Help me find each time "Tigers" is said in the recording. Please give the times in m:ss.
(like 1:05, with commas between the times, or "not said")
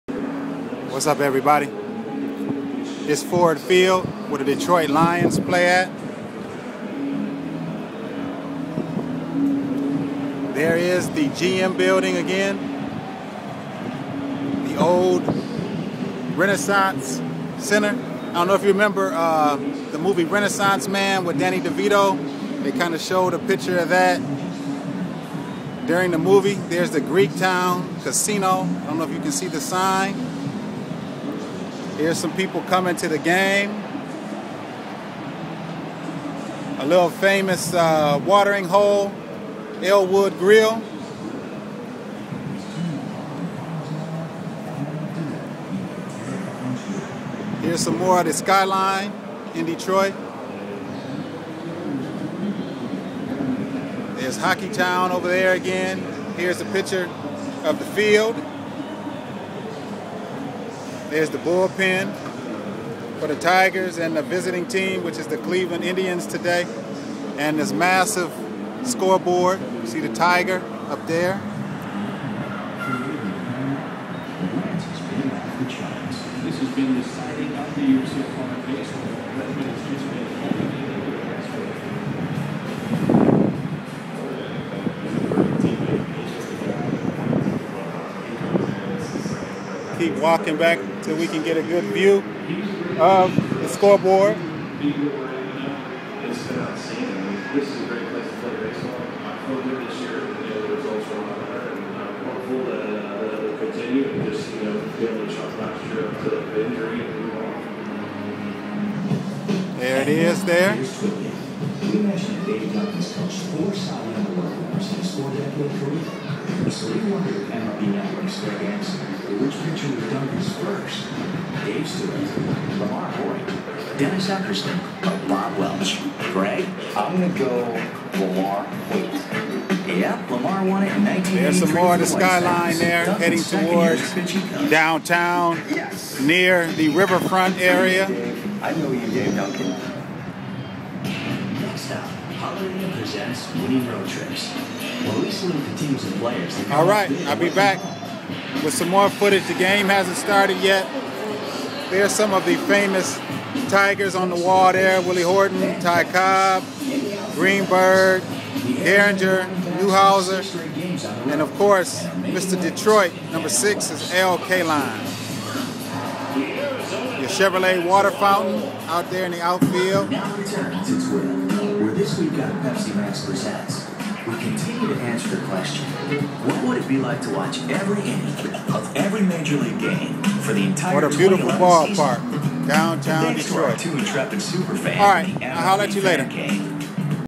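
1:03, 1:10, 2:33.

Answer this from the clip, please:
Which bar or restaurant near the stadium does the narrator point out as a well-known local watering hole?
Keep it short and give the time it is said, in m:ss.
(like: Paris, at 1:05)
Elwood Grill, at 0:39.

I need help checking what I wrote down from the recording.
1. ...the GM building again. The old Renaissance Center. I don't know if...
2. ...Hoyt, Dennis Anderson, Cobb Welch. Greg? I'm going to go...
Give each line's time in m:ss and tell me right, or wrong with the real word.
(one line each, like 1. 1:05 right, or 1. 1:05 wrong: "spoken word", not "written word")
1. 0:11 right
2. 2:03 wrong: "Bob", not "Cobb".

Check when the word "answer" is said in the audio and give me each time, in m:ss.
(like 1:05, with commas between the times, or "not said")
1:58, 2:55.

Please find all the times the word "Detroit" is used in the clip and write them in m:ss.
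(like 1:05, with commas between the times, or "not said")
0:04, 0:49, 2:42, 3:03.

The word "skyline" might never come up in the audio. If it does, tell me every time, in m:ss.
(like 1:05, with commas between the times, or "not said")
0:48, 2:12.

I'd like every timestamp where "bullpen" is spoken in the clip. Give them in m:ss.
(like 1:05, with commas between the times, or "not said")
1:01.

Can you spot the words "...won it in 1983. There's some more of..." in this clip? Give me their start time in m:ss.
2:10.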